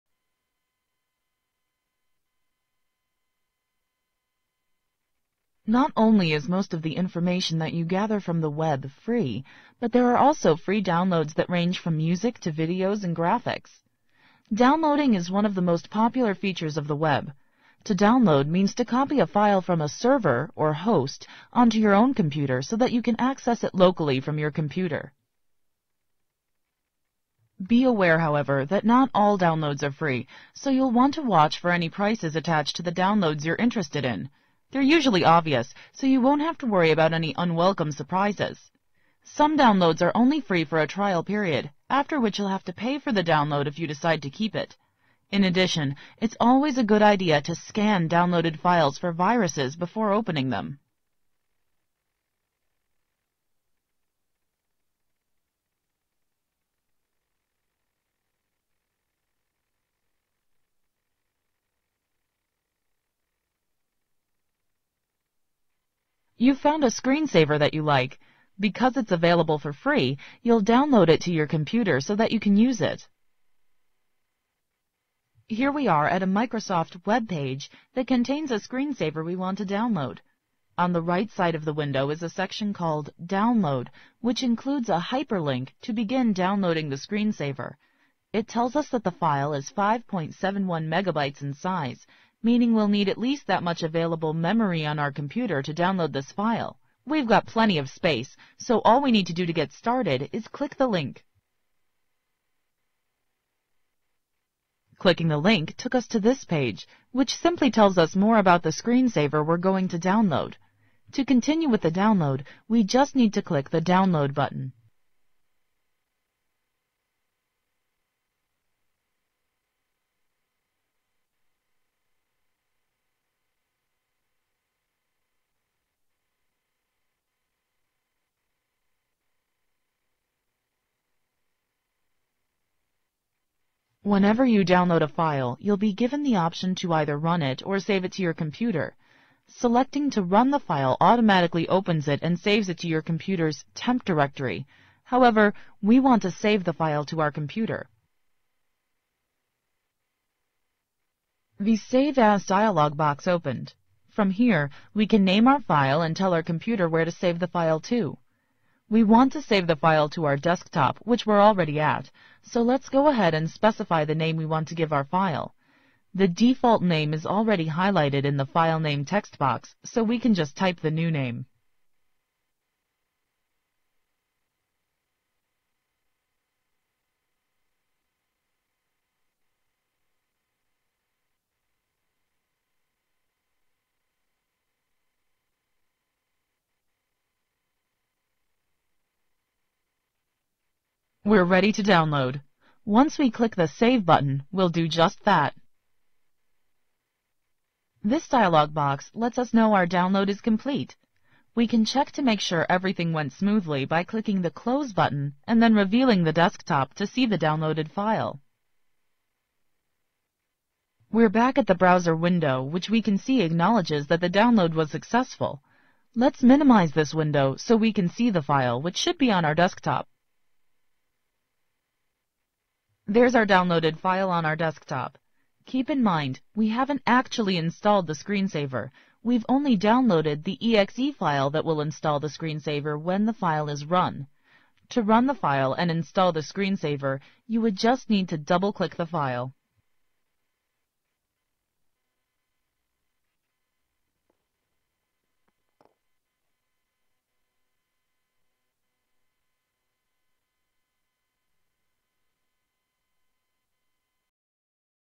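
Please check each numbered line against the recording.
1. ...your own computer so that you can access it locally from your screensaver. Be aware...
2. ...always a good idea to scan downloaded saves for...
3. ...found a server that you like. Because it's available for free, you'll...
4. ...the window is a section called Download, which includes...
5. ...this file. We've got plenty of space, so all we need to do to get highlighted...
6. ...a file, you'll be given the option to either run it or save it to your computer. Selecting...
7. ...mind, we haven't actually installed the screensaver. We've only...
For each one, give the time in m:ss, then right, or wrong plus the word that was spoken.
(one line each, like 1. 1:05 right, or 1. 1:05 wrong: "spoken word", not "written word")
1. 0:21 wrong: "computer", not "screensaver"
2. 0:46 wrong: "files", not "saves"
3. 1:06 wrong: "screensaver", not "server"
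4. 1:21 right
5. 1:36 wrong: "started", not "highlighted"
6. 2:15 right
7. 3:46 right.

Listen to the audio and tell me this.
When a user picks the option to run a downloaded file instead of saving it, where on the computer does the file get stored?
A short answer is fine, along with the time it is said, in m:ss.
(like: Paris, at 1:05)
temp directory, at 2:23.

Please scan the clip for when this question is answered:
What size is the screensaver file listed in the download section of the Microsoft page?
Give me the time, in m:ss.
1:29.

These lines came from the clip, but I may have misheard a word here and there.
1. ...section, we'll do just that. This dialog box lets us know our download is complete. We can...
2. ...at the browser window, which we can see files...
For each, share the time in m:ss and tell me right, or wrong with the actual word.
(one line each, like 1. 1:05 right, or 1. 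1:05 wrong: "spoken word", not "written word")
1. 3:14 wrong: "button", not "section"
2. 3:31 wrong: "acknowledges", not "files".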